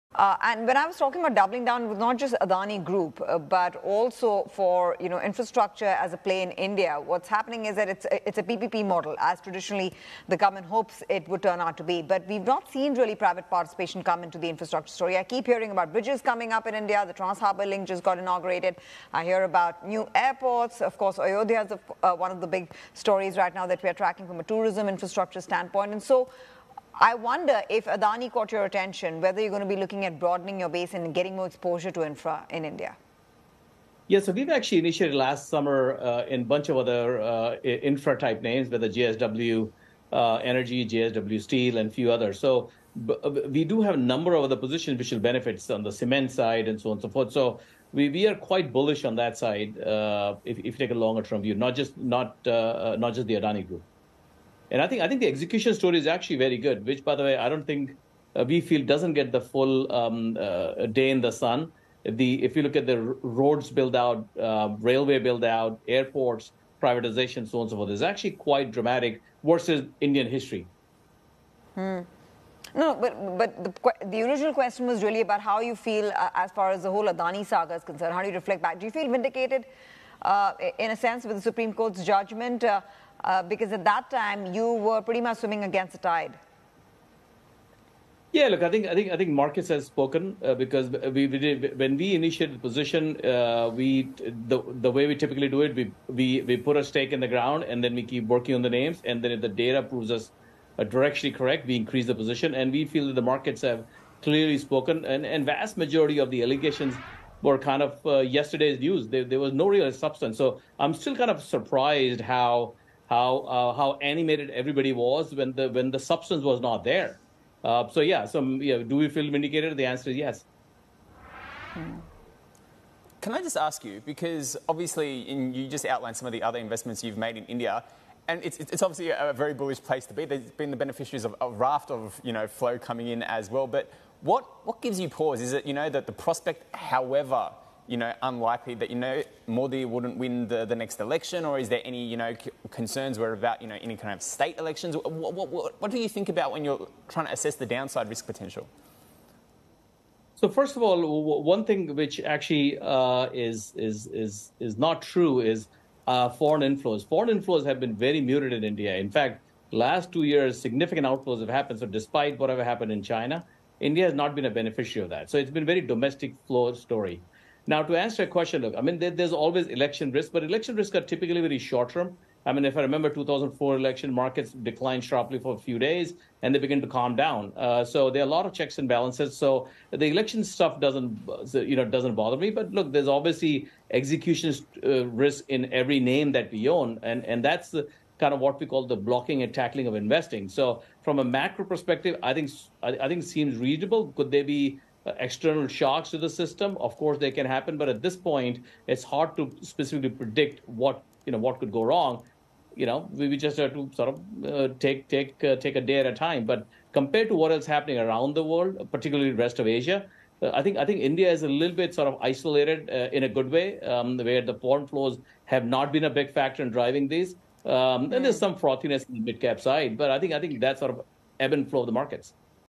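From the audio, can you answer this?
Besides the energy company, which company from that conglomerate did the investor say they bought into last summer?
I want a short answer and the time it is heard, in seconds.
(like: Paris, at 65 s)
JSW Steel, at 40 s.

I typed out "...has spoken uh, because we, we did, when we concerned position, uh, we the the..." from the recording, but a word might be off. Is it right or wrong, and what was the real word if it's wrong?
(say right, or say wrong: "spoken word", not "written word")
wrong: "initiated", not "concerned".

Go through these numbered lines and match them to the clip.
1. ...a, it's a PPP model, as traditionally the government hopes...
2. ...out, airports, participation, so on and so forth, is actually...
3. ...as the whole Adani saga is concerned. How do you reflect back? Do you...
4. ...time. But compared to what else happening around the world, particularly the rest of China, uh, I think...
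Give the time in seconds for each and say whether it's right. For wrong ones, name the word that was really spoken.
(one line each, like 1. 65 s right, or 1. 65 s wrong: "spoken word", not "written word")
1. 8 s right
2. 65 s wrong: "privatization", not "participation"
3. 76 s right
4. 206 s wrong: "Asia", not "China".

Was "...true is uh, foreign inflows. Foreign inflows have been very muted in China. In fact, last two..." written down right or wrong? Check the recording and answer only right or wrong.
wrong.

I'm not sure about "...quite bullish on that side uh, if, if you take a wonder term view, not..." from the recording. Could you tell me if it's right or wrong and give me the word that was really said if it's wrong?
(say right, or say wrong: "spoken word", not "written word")
wrong: "longer", not "wonder".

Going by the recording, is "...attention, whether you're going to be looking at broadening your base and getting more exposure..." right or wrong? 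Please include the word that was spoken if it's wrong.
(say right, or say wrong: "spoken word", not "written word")
right.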